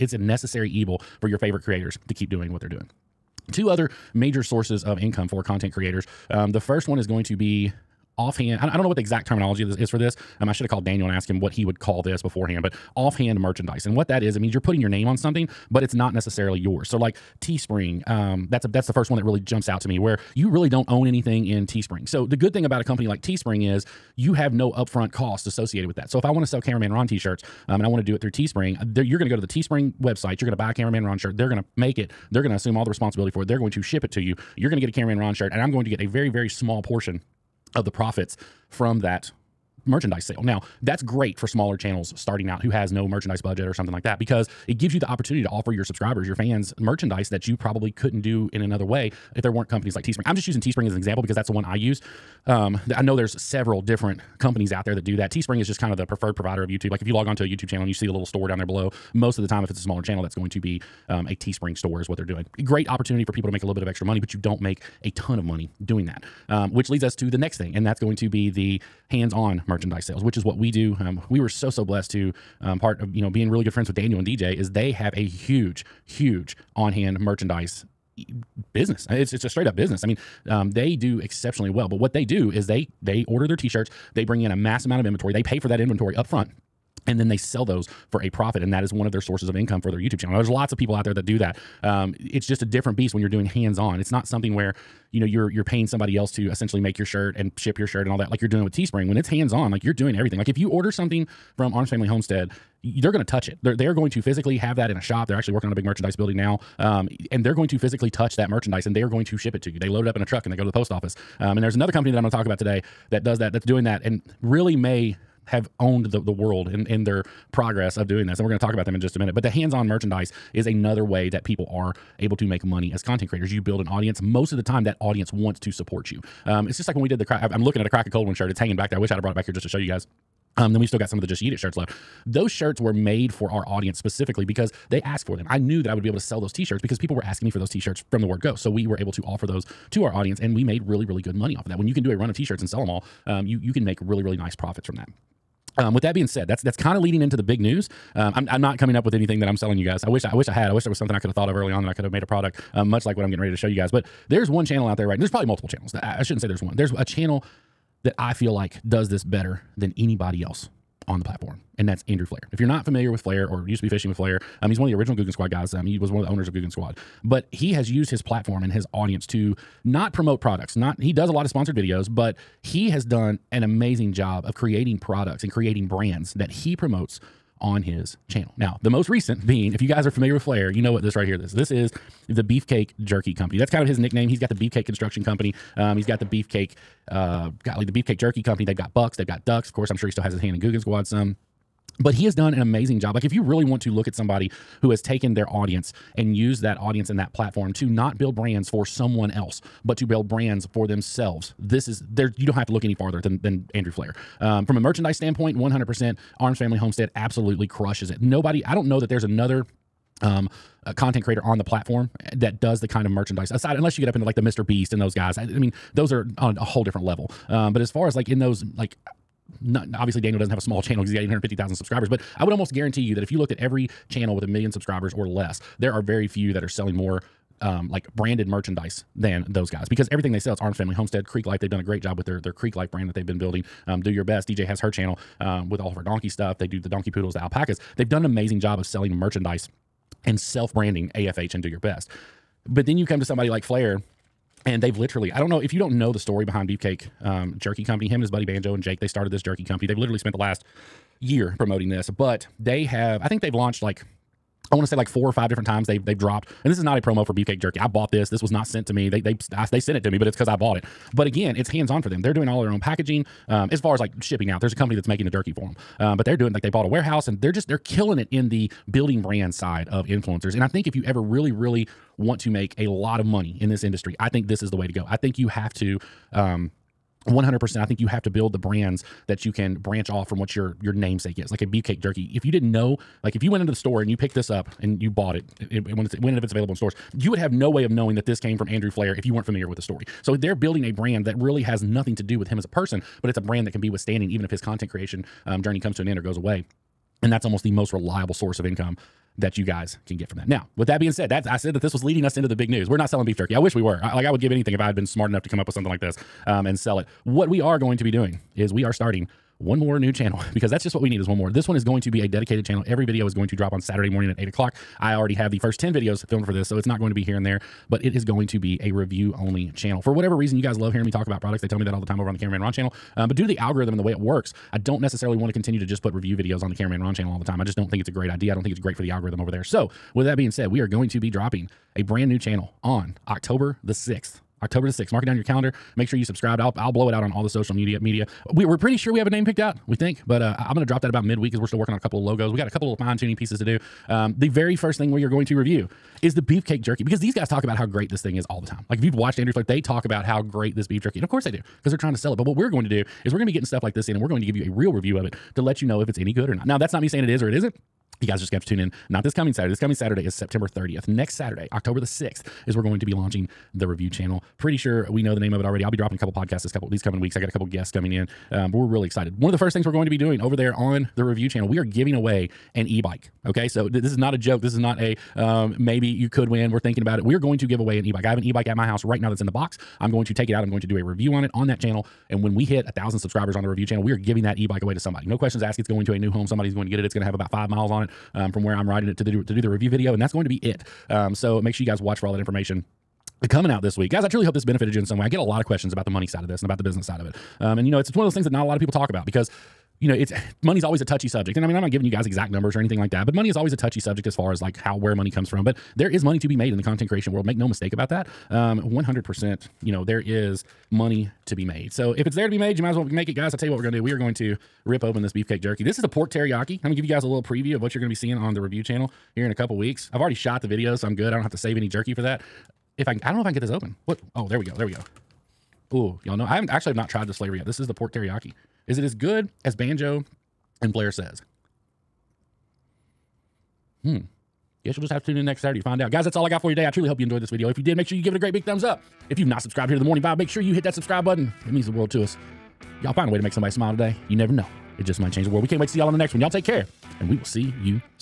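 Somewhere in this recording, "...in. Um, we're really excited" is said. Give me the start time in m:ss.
6:08.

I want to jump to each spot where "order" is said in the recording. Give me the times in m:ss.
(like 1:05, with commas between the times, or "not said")
1:23, 1:40.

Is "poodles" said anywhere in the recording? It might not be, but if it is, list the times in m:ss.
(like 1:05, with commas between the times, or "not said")
3:57.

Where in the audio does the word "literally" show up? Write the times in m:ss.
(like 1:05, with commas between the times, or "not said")
4:04, 4:09.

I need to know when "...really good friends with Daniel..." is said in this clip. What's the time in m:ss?
1:13.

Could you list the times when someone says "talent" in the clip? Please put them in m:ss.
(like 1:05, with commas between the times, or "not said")
not said.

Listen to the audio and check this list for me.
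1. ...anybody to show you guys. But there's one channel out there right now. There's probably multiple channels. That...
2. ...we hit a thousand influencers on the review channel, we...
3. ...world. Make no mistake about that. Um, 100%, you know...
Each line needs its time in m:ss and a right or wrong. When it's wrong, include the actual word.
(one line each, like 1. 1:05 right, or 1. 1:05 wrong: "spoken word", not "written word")
1. 2:33 wrong: "ready", not "anybody"
2. 6:22 wrong: "subscribers", not "influencers"
3. 6:47 right.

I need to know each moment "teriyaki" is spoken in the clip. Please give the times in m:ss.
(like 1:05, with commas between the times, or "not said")
6:56, 7:08.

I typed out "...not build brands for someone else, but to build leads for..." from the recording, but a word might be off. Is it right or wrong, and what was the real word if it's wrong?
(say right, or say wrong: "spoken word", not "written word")
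wrong: "brands", not "leads".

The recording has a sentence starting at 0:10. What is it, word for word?
Um, I should have called Daniel and asked him what he would call this beforehand, but offhand merchandise.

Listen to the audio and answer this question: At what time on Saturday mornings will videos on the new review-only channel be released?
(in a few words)
8 o'clock.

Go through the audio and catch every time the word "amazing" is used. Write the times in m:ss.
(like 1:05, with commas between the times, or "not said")
2:53, 3:12, 3:58.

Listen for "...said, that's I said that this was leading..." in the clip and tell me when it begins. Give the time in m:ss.
5:01.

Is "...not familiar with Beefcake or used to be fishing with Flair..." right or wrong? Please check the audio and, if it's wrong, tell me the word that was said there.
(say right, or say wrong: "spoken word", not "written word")
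wrong: "Flair", not "Beefcake".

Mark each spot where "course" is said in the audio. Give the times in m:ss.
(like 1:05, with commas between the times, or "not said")
3:09, 5:51.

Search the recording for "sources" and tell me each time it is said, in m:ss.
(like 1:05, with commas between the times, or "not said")
0:04, 1:29, 4:58.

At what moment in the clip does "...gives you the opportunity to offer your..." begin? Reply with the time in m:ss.
0:44.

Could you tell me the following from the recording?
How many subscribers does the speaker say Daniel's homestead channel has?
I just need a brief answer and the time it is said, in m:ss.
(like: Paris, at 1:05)
850,000, at 3:41.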